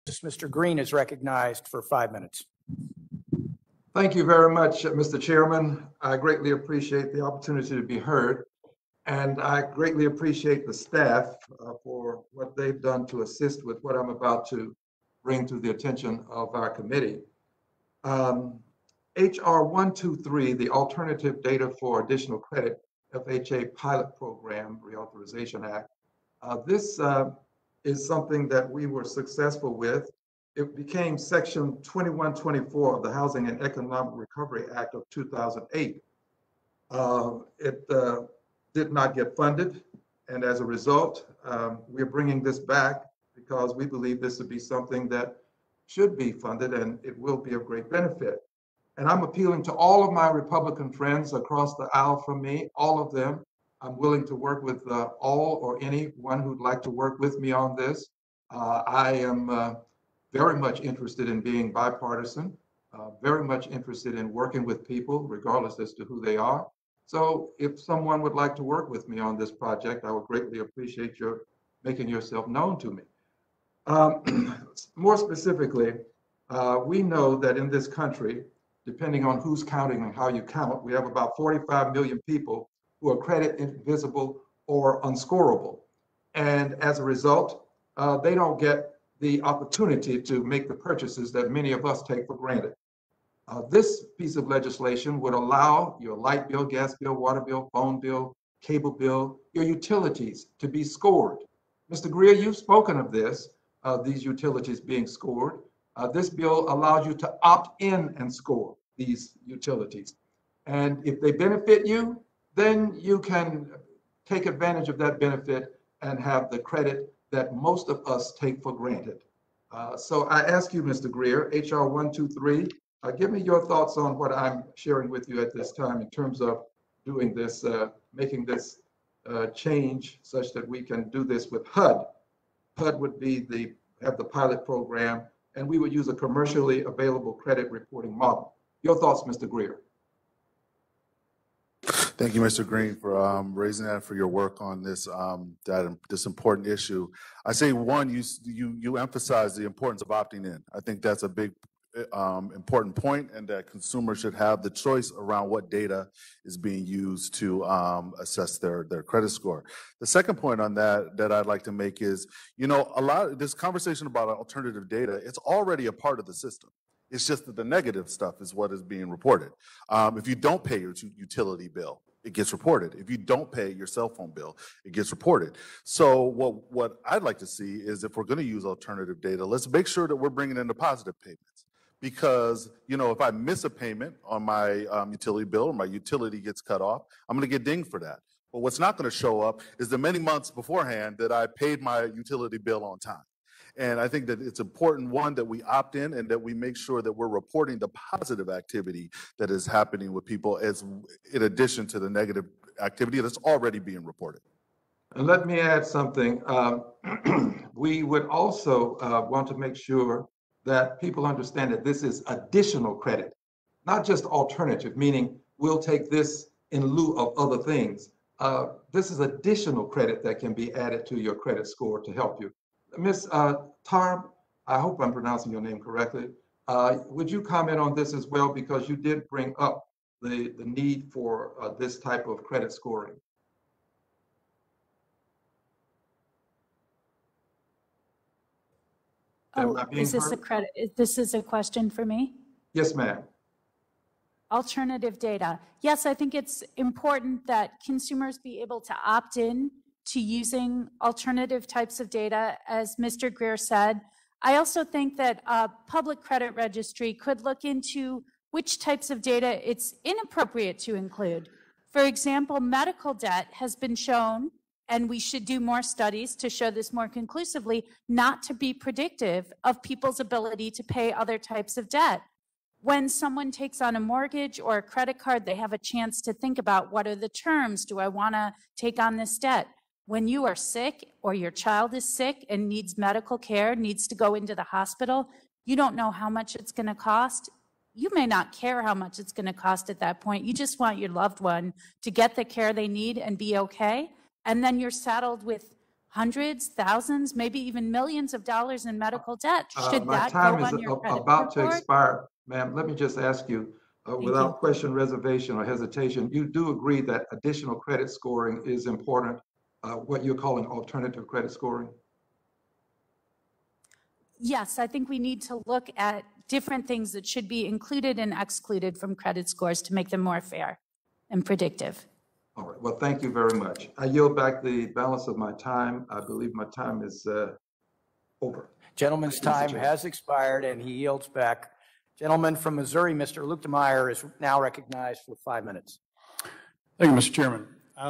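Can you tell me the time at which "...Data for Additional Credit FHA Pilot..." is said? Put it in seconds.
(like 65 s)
21 s.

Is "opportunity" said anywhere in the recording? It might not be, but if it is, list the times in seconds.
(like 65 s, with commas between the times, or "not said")
7 s, 89 s.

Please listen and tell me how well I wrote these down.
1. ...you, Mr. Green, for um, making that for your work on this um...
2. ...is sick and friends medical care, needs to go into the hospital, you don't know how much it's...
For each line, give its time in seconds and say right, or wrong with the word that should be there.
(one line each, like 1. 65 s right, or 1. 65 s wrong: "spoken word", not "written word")
1. 142 s wrong: "raising", not "making"
2. 281 s wrong: "needs", not "friends".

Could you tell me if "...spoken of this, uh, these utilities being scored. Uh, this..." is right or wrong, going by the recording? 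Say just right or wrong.
right.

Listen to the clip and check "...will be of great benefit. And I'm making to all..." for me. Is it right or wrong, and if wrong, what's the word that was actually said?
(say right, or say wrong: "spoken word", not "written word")
wrong: "appealing", not "making".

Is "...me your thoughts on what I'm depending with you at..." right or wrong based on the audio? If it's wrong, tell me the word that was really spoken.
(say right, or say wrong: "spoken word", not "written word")
wrong: "sharing", not "depending".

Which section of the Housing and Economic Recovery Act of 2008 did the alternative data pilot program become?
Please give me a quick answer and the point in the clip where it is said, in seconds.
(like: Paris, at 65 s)
Section 2124, at 31 s.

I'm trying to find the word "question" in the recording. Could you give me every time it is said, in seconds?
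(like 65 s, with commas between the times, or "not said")
241 s, 304 s.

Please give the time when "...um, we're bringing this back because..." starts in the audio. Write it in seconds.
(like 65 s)
41 s.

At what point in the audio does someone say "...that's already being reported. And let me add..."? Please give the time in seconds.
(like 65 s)
203 s.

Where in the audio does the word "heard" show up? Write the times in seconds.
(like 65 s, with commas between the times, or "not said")
7 s, 240 s.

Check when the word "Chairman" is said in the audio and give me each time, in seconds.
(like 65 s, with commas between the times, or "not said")
5 s, 337 s.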